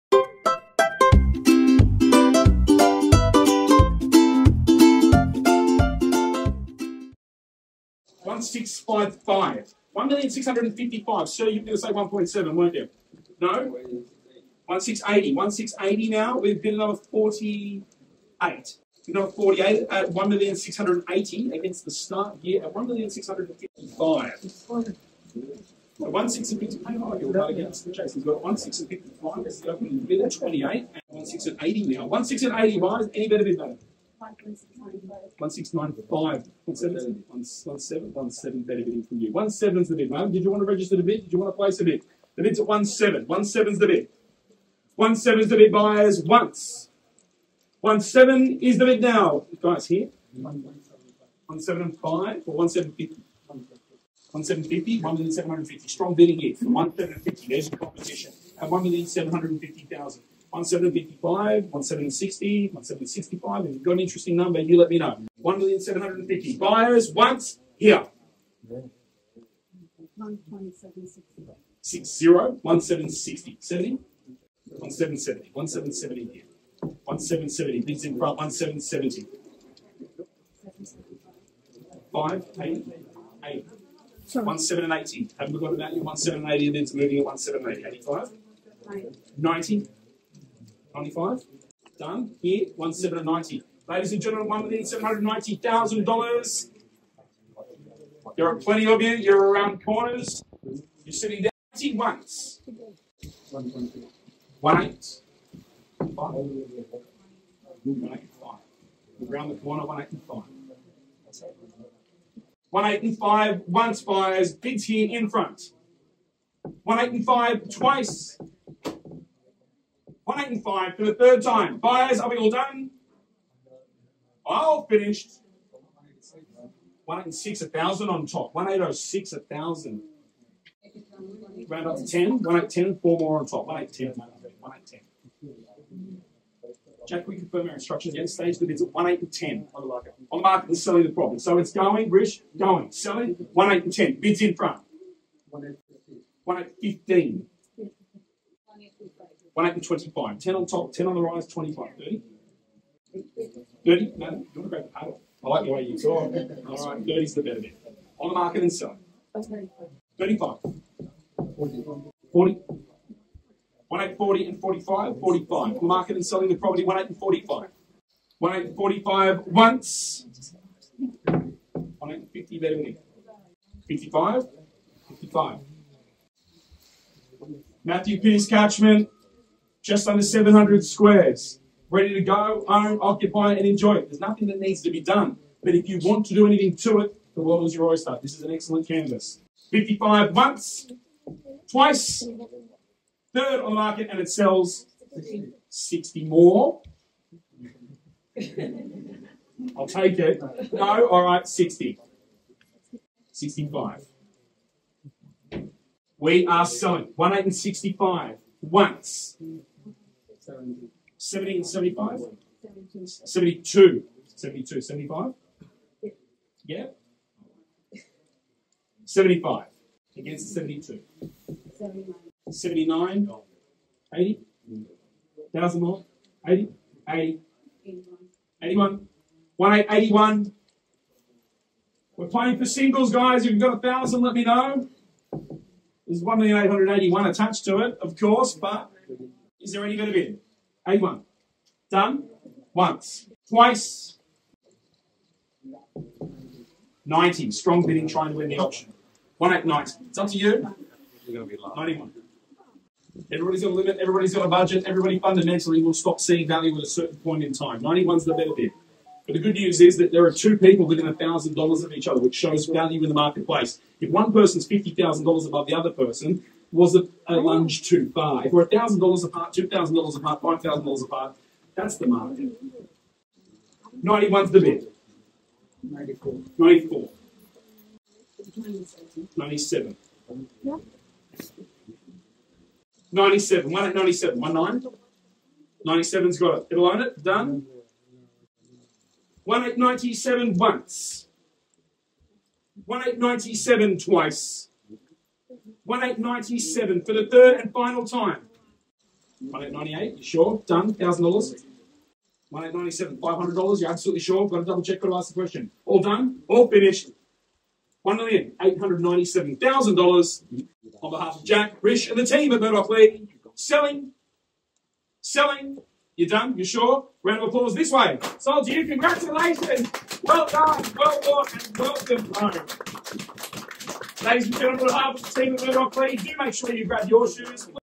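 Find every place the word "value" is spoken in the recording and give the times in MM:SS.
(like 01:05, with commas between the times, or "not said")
04:16, 04:22.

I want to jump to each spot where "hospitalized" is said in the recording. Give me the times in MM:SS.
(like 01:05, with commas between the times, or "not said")
not said.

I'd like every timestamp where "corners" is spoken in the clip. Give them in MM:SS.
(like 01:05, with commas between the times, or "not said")
01:39, 01:49.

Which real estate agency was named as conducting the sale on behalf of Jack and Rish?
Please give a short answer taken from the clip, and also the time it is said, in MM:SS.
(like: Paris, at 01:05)
Murdoch Lee, at 05:12.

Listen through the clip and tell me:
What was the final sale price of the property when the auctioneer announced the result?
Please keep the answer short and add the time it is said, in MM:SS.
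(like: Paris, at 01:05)
$1,897,000, at 05:08.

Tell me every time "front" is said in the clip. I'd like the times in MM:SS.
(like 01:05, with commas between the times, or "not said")
01:18, 01:55, 02:24.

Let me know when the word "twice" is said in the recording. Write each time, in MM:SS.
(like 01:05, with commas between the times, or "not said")
01:57, 03:11, 04:03, 04:53.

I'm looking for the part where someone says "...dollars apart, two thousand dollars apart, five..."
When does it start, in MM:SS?
04:28.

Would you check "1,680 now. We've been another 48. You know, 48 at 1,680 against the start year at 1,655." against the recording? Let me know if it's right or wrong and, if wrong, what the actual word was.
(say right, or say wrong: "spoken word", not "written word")
right.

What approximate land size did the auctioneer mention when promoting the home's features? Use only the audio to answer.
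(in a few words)
just under 700 squares.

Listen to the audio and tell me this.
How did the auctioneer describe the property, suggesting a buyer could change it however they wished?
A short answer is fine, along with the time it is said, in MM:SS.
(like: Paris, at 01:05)
an excellent canvas, at 03:08.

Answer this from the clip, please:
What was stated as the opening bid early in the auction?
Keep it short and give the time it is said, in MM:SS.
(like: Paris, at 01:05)
1,655, at 00:28.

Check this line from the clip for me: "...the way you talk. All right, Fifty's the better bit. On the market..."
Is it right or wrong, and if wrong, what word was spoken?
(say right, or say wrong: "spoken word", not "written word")
wrong: "Thirty", not "Fifty".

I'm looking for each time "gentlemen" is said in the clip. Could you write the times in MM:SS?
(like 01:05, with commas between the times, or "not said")
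01:34, 05:24.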